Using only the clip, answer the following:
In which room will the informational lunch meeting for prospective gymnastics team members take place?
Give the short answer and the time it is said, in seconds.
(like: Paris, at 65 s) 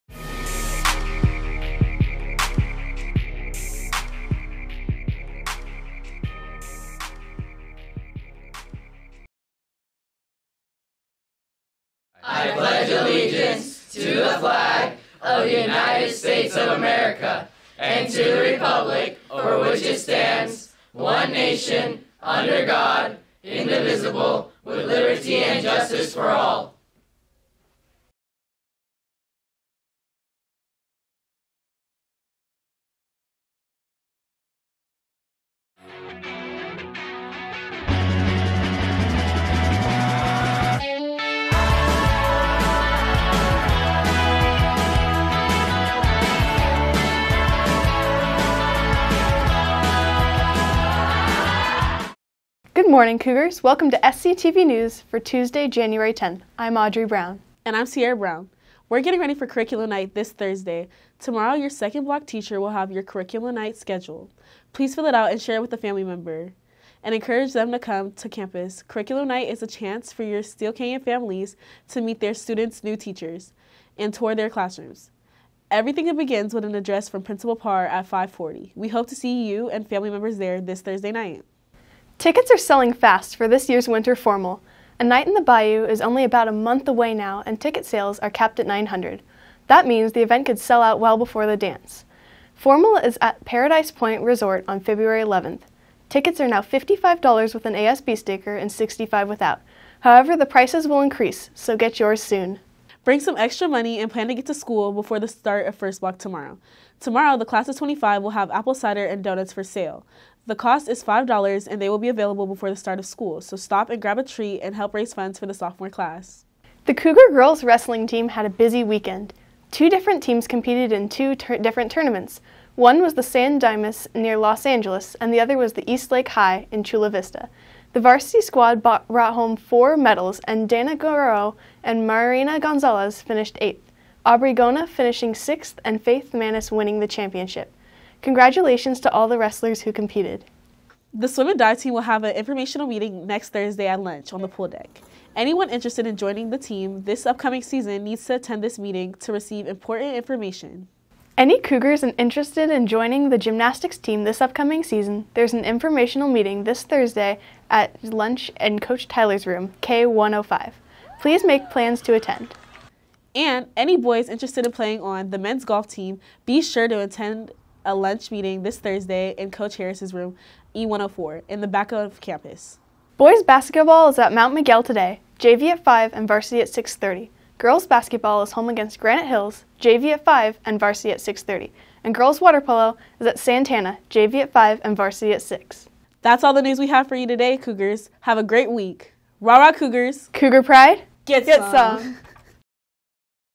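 K105, at 159 s.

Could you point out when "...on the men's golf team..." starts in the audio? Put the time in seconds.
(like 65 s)
165 s.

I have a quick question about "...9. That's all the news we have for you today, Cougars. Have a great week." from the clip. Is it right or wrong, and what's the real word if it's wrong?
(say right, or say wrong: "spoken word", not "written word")
wrong: "6", not "9".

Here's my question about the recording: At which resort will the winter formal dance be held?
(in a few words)
Paradise Point Resort.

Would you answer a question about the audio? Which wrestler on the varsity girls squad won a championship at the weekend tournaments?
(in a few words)
Faith Manis.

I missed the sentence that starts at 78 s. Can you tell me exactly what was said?
We hope to see you and family members there this Thursday night.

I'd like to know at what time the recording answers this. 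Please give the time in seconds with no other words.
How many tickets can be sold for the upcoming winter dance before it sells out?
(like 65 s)
88 s.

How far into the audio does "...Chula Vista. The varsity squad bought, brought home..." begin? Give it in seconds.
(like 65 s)
126 s.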